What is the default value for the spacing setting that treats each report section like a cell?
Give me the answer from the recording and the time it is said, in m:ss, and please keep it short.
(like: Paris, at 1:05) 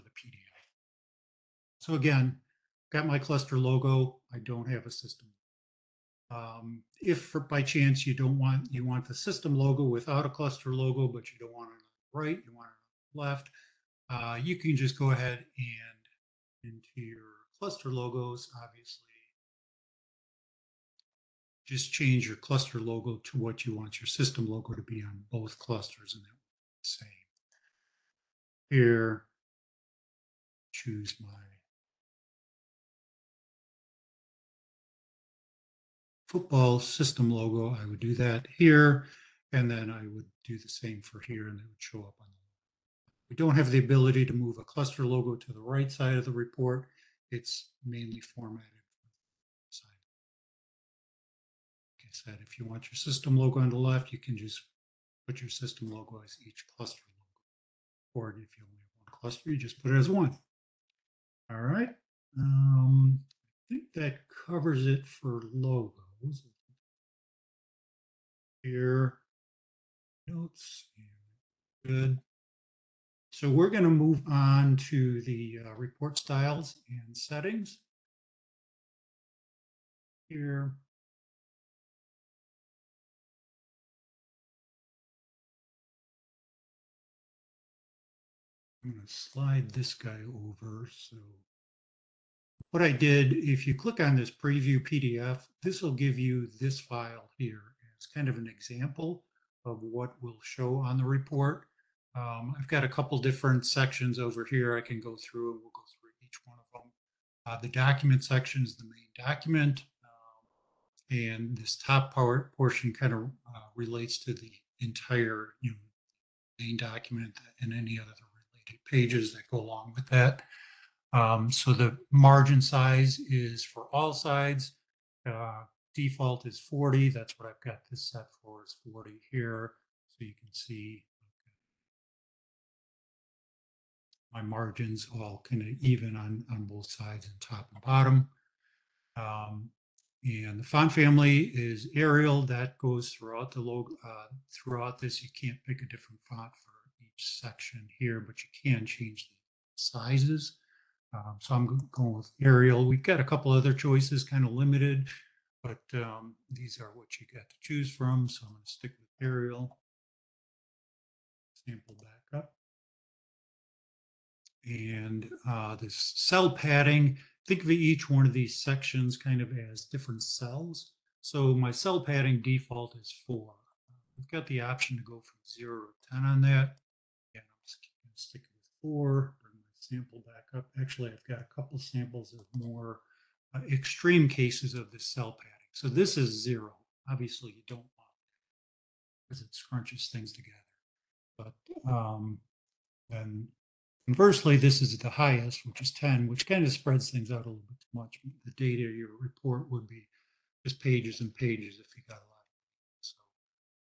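4, at 2:52.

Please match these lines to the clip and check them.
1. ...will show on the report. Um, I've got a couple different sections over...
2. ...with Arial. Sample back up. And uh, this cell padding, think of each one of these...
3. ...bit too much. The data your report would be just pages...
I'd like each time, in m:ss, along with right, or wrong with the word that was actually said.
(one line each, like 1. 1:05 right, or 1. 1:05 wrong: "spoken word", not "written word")
1. 1:40 right
2. 2:38 right
3. 3:17 right.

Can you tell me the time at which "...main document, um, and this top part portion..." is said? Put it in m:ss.
1:48.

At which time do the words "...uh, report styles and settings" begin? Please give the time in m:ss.
1:15.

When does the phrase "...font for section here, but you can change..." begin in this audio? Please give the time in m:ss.
2:26.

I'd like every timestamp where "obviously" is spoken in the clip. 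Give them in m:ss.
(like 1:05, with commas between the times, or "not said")
0:18, 3:07.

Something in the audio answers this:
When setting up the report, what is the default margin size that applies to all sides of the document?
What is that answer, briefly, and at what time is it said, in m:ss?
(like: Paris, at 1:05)
40, at 2:05.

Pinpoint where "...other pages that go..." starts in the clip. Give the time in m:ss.
1:57.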